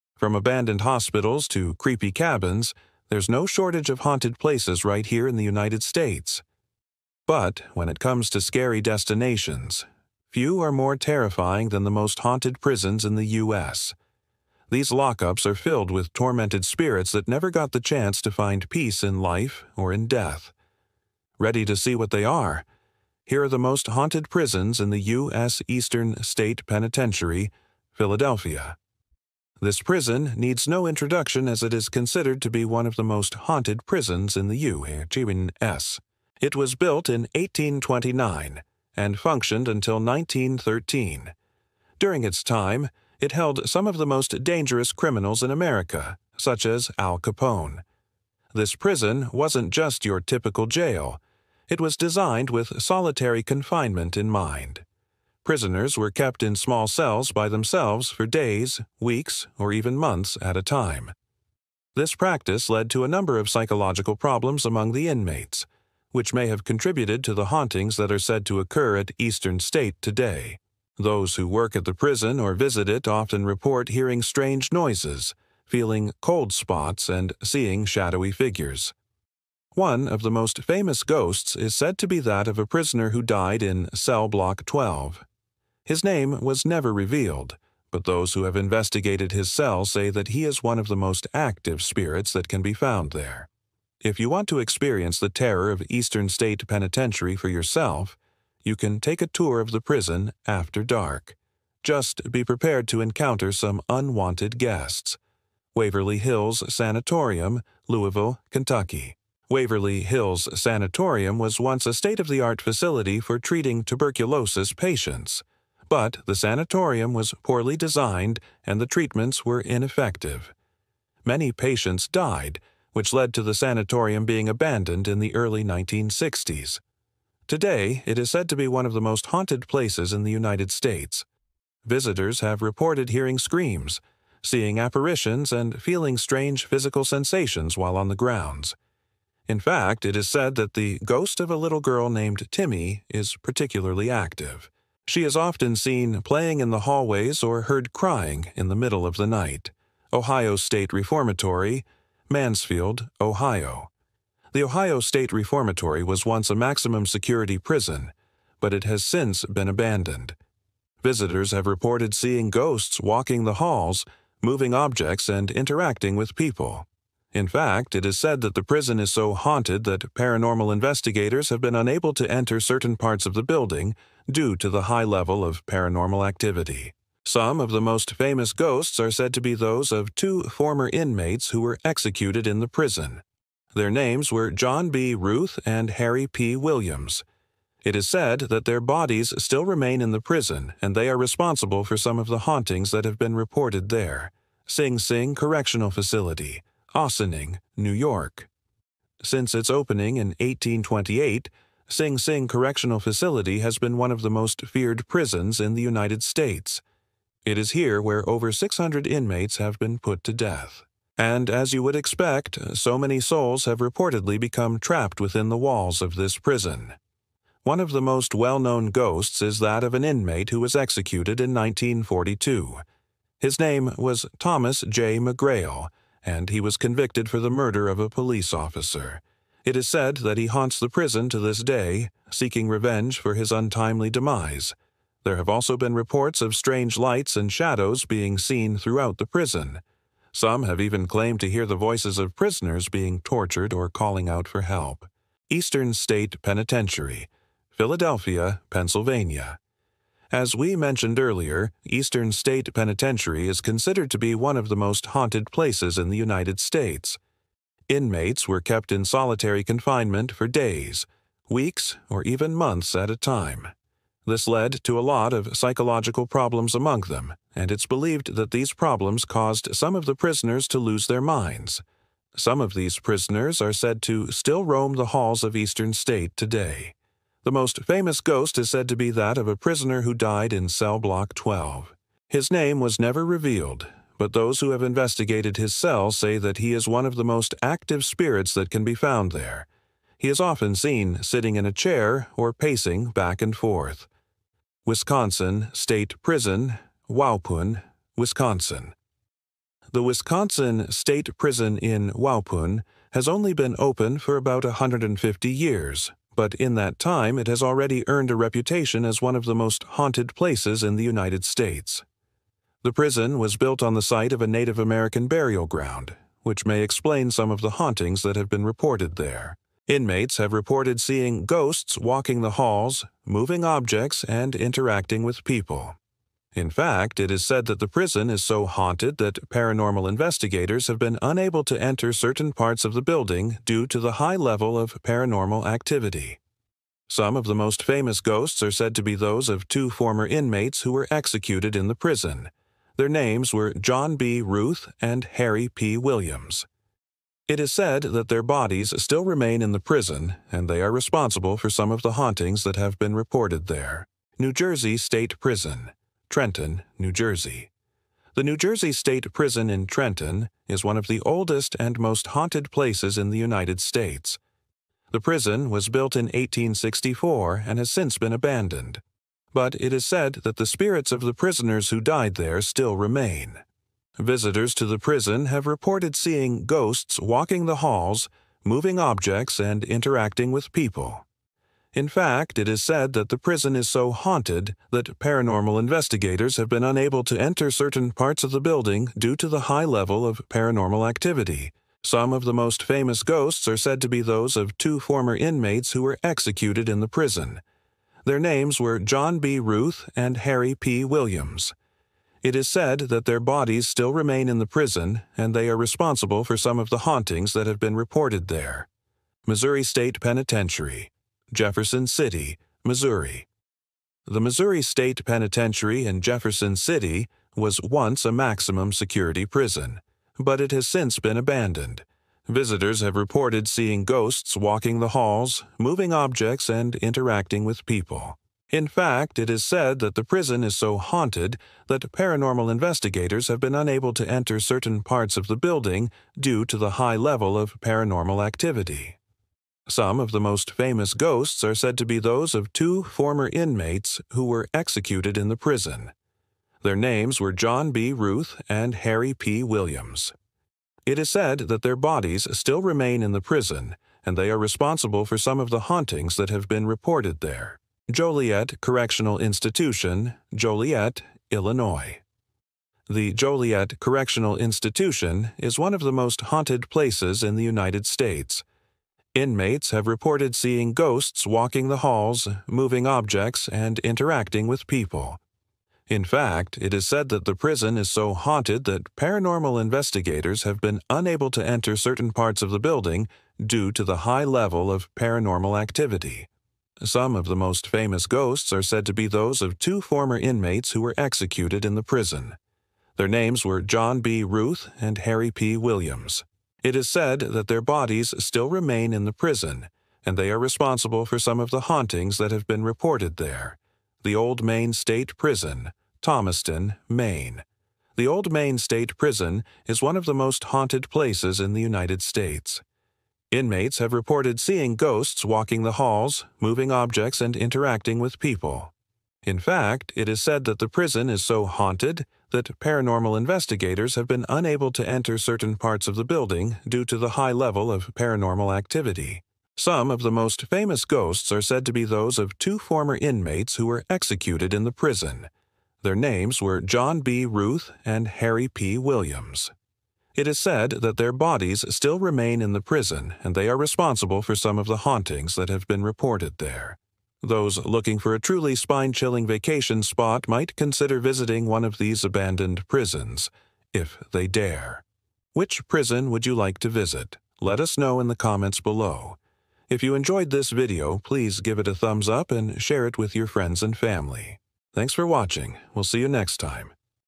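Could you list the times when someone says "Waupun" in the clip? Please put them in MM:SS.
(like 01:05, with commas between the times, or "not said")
04:57, 05:02.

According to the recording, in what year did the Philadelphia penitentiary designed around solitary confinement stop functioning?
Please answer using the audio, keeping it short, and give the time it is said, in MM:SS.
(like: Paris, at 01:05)
1913, at 00:39.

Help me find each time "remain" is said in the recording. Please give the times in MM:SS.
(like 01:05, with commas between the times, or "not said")
03:09, 05:49, 06:12, 06:44, 07:32, 08:18, 09:02.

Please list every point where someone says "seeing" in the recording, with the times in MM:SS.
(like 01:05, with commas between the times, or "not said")
01:17, 02:14, 02:42, 05:20, 06:16, 07:03, 07:50, 08:34.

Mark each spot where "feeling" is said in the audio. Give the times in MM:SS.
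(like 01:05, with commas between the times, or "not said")
01:15, 02:15.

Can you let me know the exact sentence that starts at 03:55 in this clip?
There have also been reports of strange lights and shadows being seen throughout the prison.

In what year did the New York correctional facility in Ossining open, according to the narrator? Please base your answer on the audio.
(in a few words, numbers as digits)
1828.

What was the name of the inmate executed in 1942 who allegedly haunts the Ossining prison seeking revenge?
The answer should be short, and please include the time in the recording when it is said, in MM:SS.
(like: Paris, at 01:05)
Thomas J. McGrail, at 03:44.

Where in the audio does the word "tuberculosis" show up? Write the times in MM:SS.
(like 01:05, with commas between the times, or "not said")
01:53.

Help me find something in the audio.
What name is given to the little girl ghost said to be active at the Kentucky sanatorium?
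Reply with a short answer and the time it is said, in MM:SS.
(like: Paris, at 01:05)
Timmy, at 02:22.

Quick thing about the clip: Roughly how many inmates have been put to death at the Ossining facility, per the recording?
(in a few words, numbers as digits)
over 600.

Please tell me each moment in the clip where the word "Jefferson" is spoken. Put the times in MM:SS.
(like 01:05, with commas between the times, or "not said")
06:51, 06:56.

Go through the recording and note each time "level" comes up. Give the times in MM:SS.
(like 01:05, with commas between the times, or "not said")
02:55, 05:34, 06:29, 07:17, 08:04, 08:47.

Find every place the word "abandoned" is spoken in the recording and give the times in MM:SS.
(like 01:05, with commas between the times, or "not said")
00:00, 02:04, 02:39, 06:08, 07:01, 09:12.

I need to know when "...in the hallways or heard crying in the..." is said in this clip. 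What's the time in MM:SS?
02:26.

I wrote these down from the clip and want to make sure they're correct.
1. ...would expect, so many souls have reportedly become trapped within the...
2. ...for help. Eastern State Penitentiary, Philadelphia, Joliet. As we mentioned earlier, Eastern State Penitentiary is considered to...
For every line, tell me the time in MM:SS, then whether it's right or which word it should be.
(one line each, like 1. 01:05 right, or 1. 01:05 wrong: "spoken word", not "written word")
1. 03:31 right
2. 04:04 wrong: "Pennsylvania", not "Joliet".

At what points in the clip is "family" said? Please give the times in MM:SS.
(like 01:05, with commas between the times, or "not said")
09:23.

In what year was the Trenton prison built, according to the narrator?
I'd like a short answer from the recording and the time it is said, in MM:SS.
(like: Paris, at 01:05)
1864, at 06:06.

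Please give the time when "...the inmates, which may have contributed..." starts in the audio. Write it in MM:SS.
01:04.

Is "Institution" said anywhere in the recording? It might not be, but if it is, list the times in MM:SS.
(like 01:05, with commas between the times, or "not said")
07:39, 07:44.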